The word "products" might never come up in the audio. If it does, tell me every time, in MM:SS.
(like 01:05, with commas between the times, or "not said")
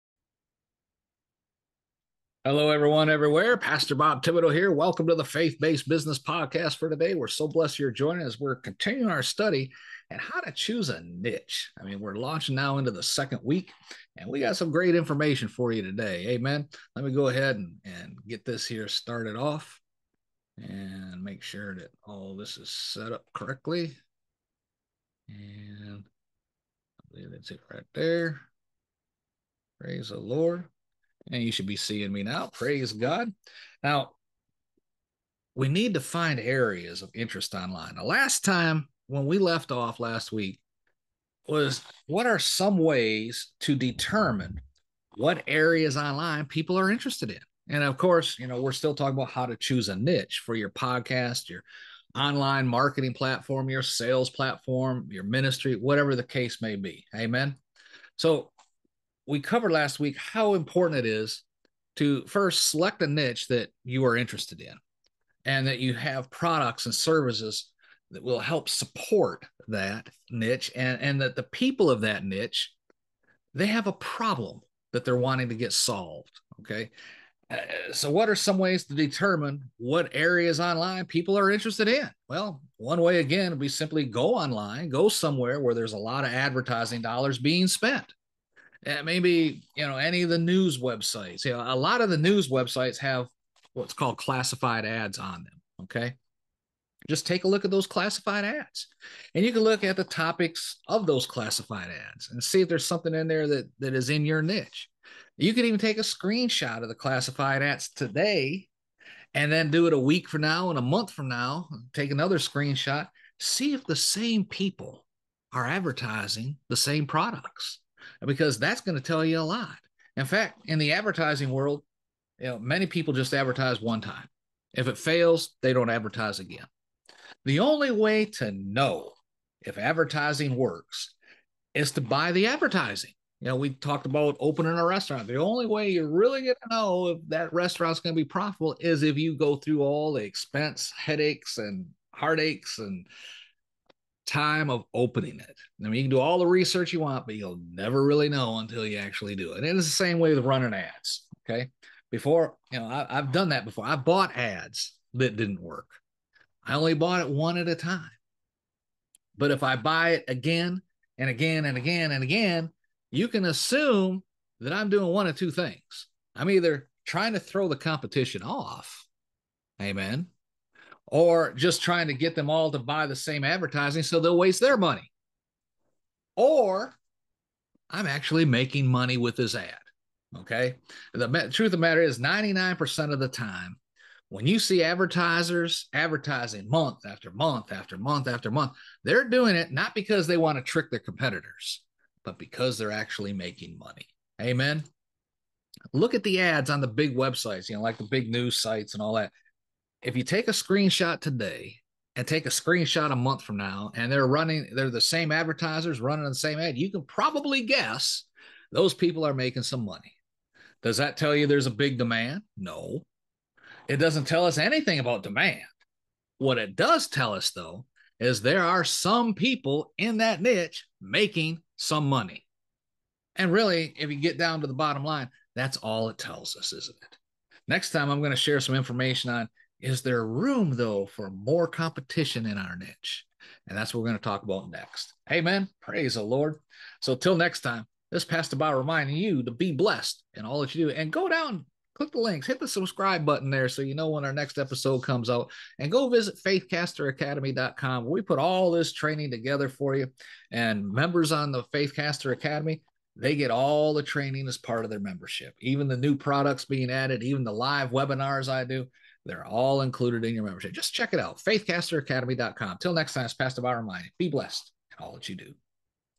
01:06, 01:57, 04:16.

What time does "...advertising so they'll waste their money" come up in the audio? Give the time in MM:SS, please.
02:53.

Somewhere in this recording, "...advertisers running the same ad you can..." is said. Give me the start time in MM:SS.
03:25.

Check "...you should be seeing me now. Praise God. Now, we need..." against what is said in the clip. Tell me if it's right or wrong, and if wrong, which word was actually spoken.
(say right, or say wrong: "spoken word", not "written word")
right.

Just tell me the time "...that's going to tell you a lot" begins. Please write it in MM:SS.
01:58.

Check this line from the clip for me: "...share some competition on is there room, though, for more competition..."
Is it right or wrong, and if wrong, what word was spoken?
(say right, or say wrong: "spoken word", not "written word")
wrong: "information", not "competition".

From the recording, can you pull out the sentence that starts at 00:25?
And I believe that's it right there.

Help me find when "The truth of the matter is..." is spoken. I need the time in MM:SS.
03:01.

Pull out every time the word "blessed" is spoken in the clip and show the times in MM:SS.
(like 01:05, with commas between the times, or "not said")
00:07, 03:59, 04:24.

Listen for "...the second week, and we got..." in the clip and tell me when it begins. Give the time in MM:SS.
00:12.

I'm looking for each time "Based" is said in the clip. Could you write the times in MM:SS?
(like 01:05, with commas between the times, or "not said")
00:05.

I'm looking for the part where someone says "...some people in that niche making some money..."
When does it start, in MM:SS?
03:38.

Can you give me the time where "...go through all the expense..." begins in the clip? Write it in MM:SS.
02:19.